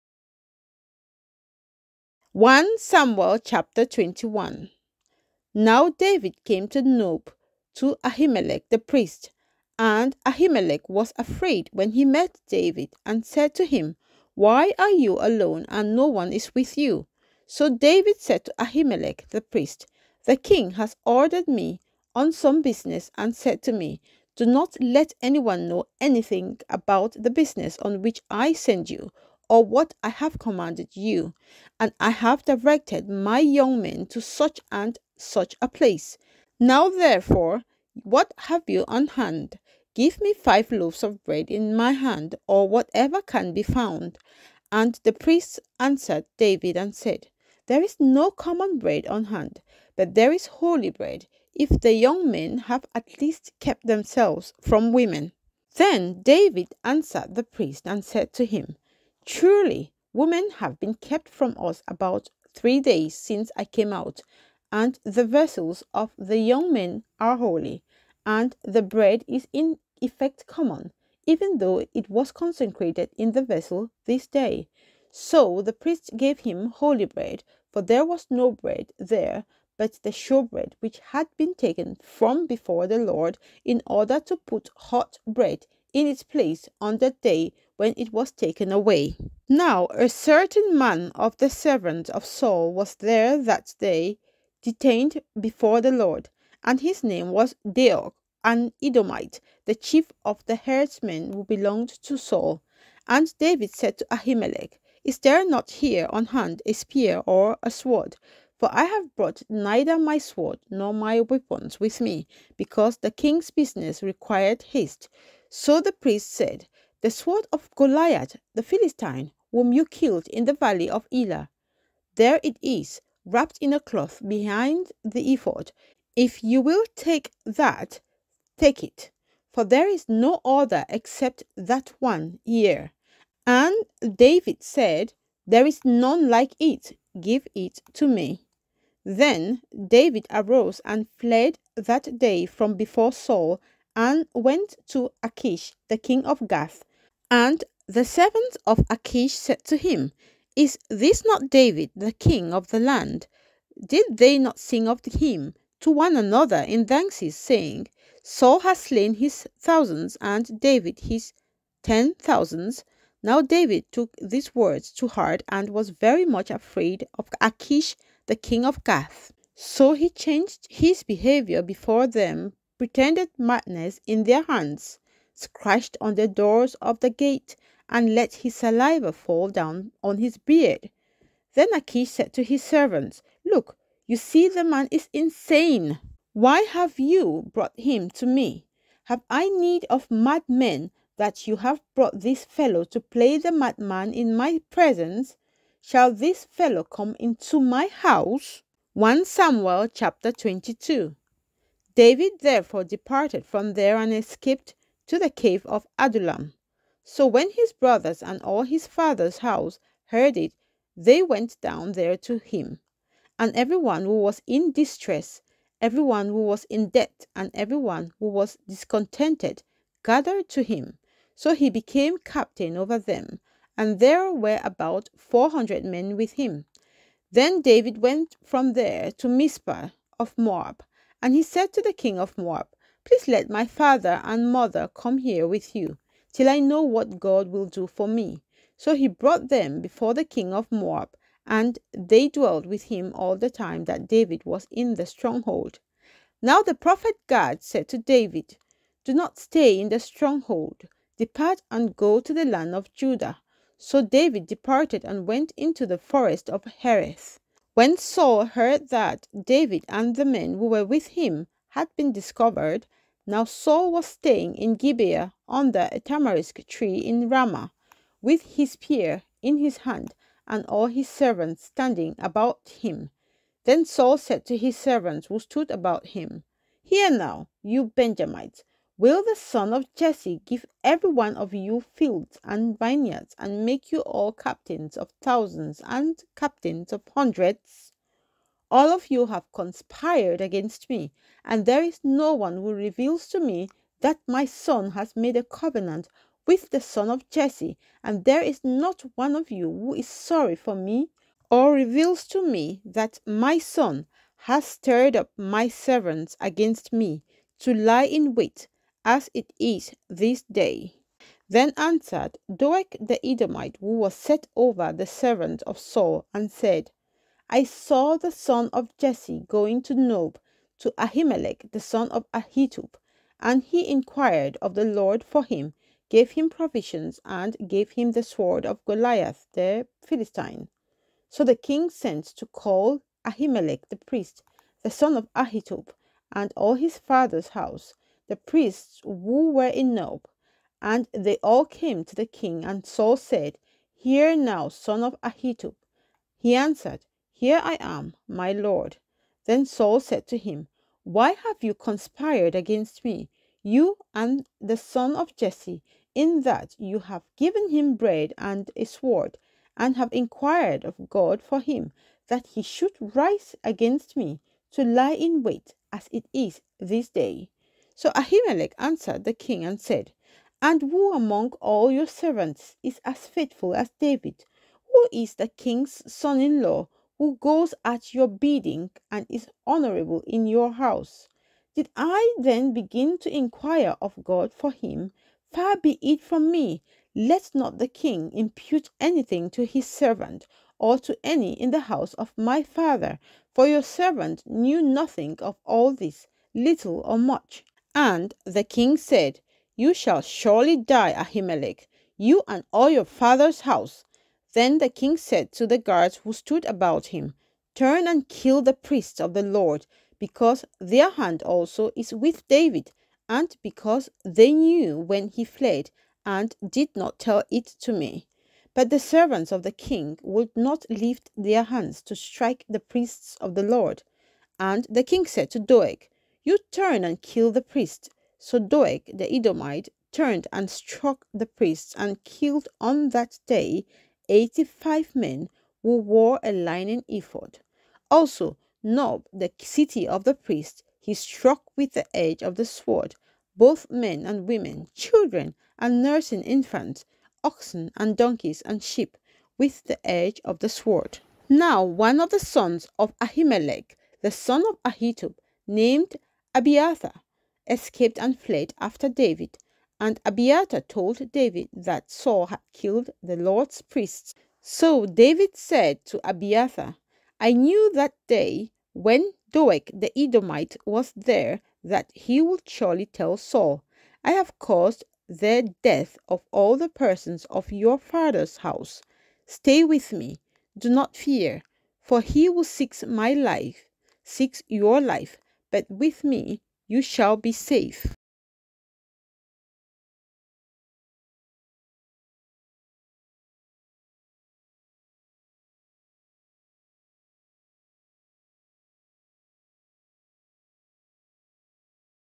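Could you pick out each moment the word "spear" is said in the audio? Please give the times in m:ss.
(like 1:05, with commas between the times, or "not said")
1:46, 4:28.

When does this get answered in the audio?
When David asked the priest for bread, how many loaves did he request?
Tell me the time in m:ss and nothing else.
0:40.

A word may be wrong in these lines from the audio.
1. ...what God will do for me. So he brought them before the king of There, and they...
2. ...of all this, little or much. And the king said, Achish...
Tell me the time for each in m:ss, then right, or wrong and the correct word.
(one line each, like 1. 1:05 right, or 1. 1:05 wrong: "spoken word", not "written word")
1. 3:56 wrong: "Moab", not "There"
2. 6:35 wrong: "You", not "Achish".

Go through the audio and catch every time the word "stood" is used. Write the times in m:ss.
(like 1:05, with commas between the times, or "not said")
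4:35, 6:46.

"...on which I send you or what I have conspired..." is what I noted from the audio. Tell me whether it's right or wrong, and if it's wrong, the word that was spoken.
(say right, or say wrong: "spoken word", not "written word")
wrong: "commanded", not "conspired".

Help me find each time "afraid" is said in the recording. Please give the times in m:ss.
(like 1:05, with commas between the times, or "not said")
0:11, 2:46.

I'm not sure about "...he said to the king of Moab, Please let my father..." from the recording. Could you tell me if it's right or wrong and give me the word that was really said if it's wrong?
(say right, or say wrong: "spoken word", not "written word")
right.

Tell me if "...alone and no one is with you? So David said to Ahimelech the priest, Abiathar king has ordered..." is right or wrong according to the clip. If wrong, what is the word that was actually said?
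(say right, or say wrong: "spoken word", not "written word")
wrong: "The", not "Abiathar".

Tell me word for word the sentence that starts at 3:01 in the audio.
Then Achish said to his servants, Look, you see the man is insane.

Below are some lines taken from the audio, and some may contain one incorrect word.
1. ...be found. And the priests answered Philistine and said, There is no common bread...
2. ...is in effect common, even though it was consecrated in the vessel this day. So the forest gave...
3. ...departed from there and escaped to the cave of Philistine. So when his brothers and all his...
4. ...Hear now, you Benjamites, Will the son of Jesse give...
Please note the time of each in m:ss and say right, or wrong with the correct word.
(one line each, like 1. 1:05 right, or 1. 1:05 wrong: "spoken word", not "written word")
1. 0:43 wrong: "David", not "Philistine"
2. 1:09 wrong: "priest", not "forest"
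3. 3:22 wrong: "Adullam", not "Philistine"
4. 4:36 right.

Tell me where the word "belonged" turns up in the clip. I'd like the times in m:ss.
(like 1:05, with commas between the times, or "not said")
1:41.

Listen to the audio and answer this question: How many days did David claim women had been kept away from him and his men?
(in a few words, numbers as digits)
3.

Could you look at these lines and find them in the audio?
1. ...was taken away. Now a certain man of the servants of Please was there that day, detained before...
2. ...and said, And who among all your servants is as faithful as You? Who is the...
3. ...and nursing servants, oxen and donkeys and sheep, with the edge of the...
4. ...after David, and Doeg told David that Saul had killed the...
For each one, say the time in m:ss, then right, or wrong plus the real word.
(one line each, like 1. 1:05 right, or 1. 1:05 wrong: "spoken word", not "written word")
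1. 1:28 wrong: "Saul", not "Please"
2. 6:09 wrong: "David", not "You"
3. 7:25 wrong: "infants", not "servants"
4. 7:38 wrong: "Abiathar", not "Doeg".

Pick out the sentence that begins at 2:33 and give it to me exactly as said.
Did they not sing of him to one another in dances, saying, Saul has slain his thousands, and David his ten thousands?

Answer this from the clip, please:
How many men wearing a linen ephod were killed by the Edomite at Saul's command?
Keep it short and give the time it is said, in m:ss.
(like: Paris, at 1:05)
85, at 7:14.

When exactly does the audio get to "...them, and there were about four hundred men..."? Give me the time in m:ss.
3:42.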